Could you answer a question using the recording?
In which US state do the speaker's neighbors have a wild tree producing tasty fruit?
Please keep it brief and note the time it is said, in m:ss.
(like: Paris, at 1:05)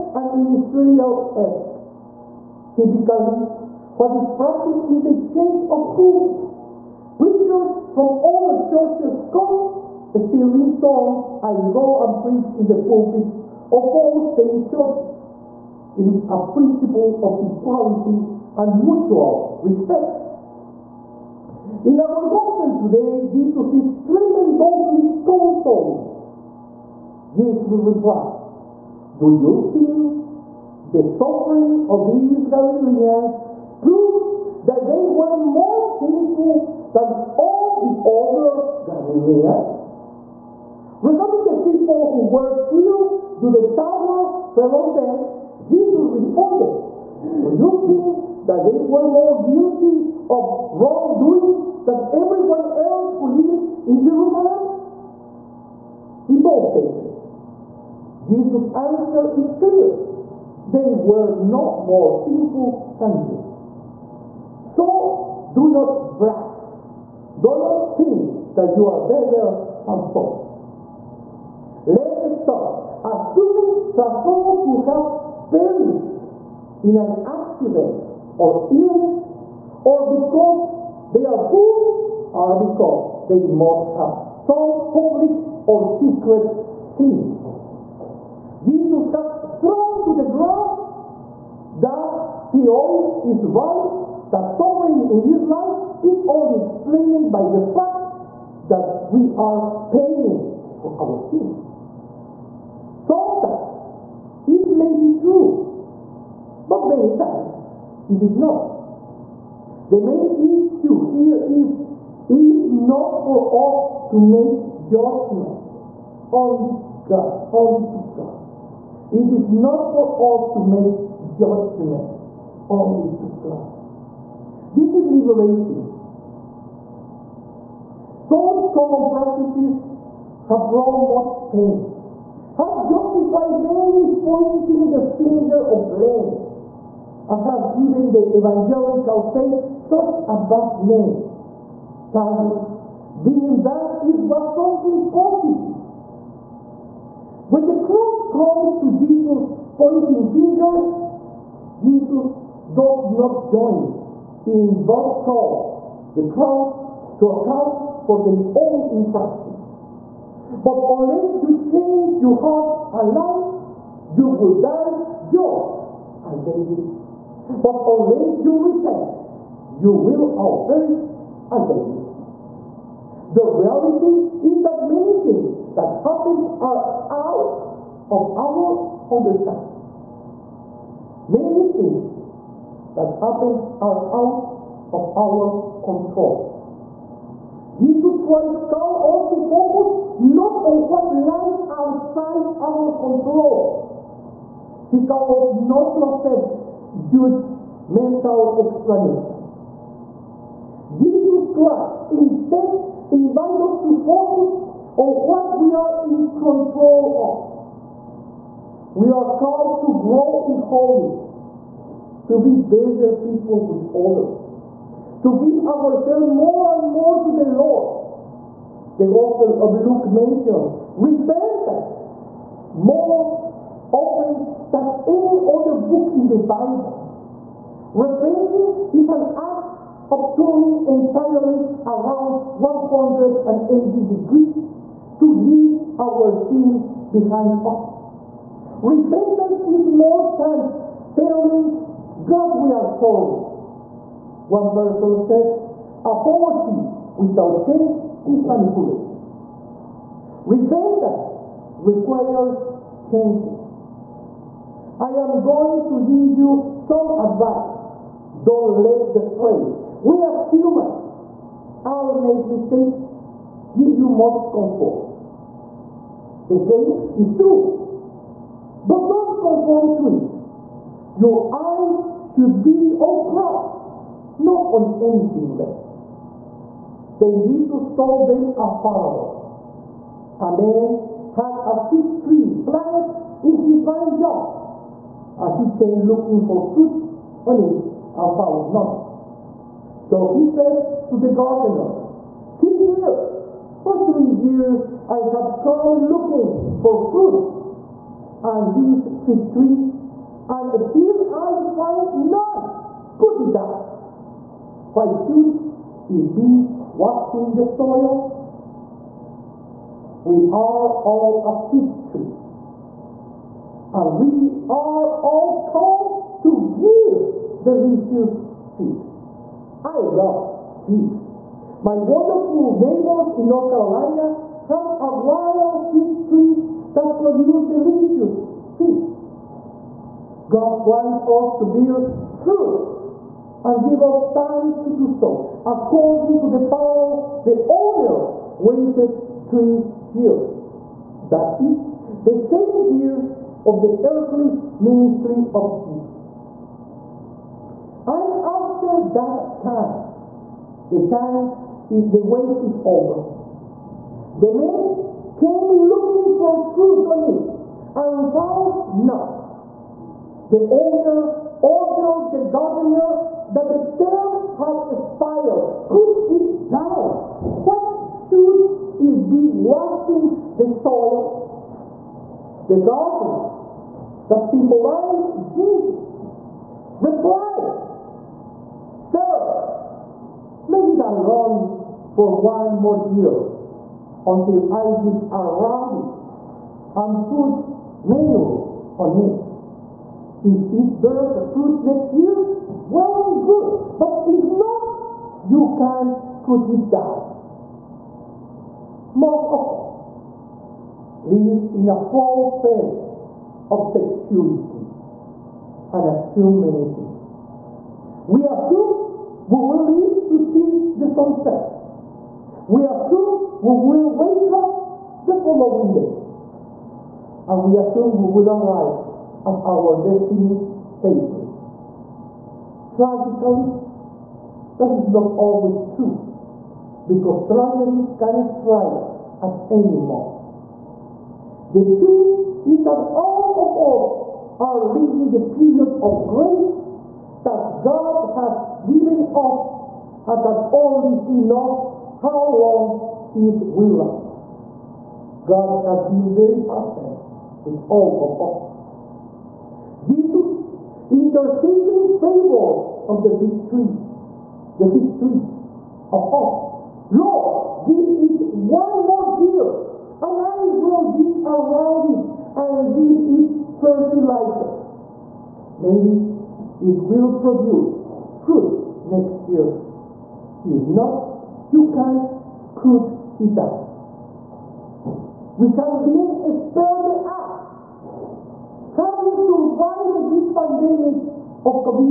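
North Carolina, at 5:23.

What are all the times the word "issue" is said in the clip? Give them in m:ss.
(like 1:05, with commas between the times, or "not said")
1:50.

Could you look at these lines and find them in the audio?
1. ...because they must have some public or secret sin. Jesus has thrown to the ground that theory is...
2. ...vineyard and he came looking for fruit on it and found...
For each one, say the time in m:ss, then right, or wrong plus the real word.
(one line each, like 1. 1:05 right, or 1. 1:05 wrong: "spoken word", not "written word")
1. 1:22 right
2. 4:43 right.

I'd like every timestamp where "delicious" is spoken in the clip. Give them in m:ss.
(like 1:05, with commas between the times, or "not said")
5:17, 5:27.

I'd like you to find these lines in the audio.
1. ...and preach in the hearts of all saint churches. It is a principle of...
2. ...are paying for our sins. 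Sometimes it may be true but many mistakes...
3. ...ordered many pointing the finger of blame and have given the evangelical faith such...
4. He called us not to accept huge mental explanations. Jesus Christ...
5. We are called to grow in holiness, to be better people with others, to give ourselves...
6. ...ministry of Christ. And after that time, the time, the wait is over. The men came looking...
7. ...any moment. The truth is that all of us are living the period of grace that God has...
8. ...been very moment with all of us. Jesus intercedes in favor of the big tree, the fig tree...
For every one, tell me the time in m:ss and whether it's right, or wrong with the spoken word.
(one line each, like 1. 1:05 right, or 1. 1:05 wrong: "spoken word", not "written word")
1. 0:12 wrong: "pulpits", not "hearts"
2. 1:39 wrong: "times", not "mistakes"
3. 2:12 wrong: "justified", not "ordered"
4. 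3:14 right
5. 3:28 right
6. 5:44 wrong: "Jesus", not "Christ"
7. 7:09 right
8. 7:26 wrong: "patient", not "moment".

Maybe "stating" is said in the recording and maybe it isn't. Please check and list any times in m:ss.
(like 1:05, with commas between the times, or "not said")
not said.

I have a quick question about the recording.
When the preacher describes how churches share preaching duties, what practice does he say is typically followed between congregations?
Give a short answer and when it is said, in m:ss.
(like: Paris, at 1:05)
change of pulpits, at 0:05.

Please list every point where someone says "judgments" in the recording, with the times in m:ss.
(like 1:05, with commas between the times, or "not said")
1:54, 2:01.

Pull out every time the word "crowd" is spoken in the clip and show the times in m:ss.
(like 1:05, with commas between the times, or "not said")
2:27, 2:36.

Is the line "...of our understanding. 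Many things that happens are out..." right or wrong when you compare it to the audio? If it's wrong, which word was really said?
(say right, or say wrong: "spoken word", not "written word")
right.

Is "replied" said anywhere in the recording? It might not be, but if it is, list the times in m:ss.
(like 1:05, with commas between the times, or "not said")
0:27, 6:17.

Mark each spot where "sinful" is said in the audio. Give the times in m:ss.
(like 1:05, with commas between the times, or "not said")
0:35, 1:02.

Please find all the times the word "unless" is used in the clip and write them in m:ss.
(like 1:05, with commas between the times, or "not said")
2:40, 2:47.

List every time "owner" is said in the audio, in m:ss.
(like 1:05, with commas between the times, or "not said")
5:37, 6:00.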